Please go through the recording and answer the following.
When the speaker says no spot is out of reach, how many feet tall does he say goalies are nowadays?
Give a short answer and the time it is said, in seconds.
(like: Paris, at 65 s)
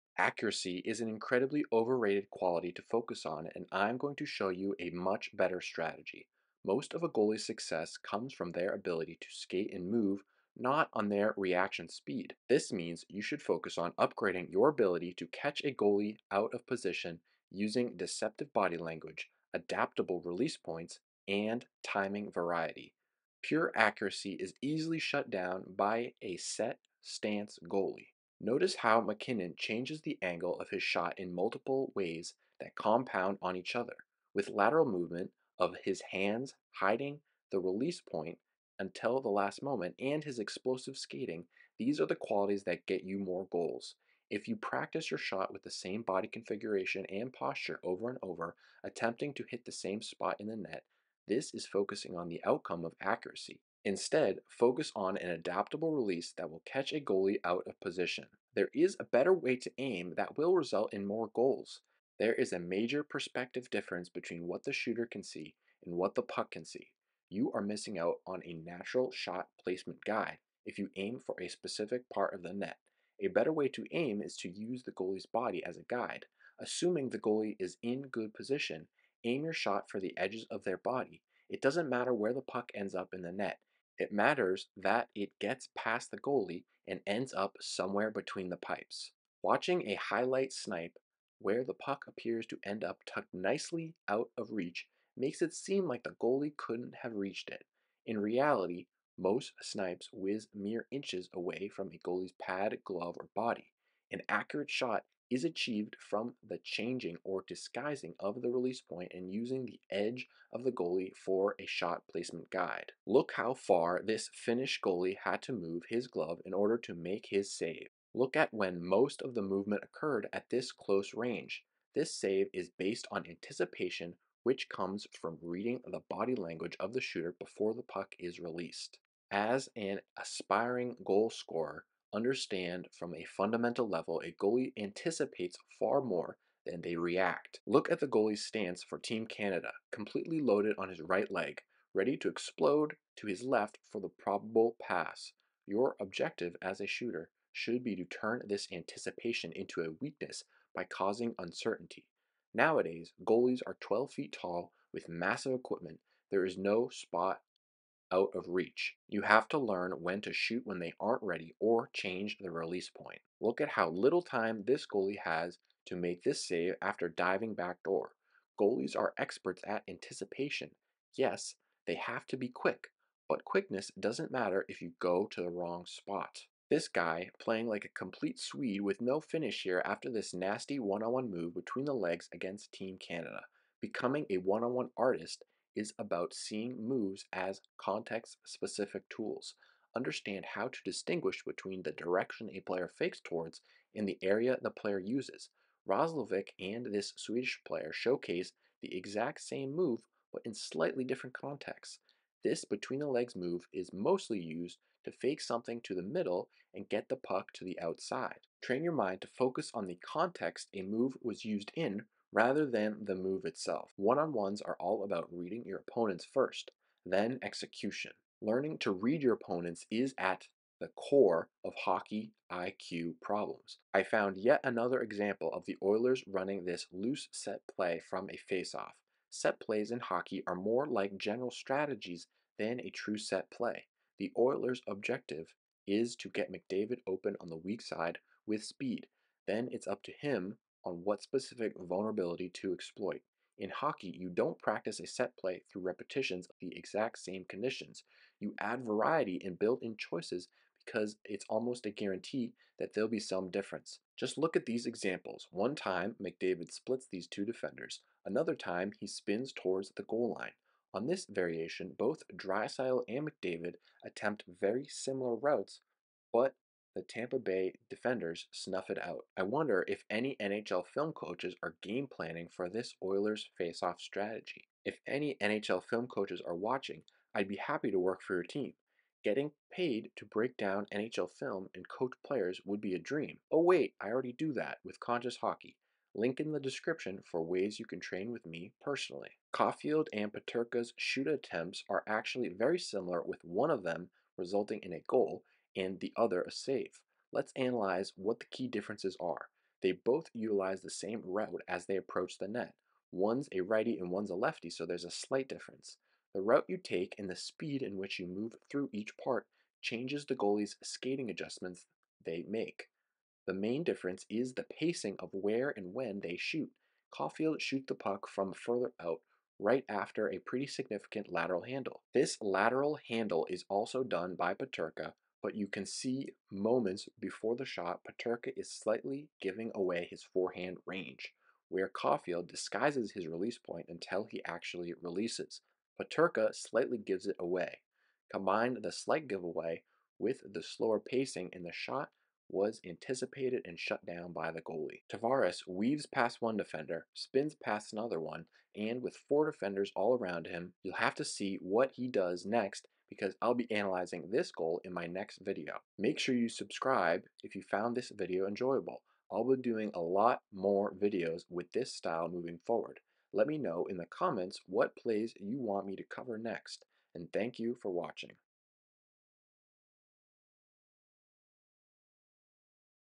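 12, at 153 s.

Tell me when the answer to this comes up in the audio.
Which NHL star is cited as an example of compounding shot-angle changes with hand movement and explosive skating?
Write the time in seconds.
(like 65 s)
29 s.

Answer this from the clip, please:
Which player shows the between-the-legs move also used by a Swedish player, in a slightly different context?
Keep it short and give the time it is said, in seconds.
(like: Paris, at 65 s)
Roslovic, at 195 s.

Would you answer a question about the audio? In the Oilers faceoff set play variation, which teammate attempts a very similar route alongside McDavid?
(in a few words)
Drysdale.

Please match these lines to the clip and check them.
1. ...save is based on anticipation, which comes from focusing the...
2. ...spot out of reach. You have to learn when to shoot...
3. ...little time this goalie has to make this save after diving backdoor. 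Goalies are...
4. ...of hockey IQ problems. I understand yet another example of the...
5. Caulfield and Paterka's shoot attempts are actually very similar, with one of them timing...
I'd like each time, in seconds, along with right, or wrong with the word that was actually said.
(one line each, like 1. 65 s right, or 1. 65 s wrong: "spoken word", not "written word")
1. 122 s wrong: "reading", not "focusing"
2. 156 s right
3. 163 s right
4. 221 s wrong: "found", not "understand"
5. 289 s wrong: "resulting", not "timing".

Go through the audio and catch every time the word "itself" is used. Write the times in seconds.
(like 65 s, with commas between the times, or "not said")
213 s.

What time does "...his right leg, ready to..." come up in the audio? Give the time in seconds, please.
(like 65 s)
140 s.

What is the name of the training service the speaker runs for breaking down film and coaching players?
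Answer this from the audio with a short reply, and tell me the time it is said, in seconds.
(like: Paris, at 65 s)
Conscious Hockey, at 284 s.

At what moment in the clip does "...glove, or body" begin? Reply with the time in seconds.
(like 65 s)
102 s.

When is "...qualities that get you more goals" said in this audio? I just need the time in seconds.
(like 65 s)
42 s.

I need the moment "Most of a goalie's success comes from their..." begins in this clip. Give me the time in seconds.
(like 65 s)
6 s.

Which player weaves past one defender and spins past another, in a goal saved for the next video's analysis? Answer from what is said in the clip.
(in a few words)
Tavares.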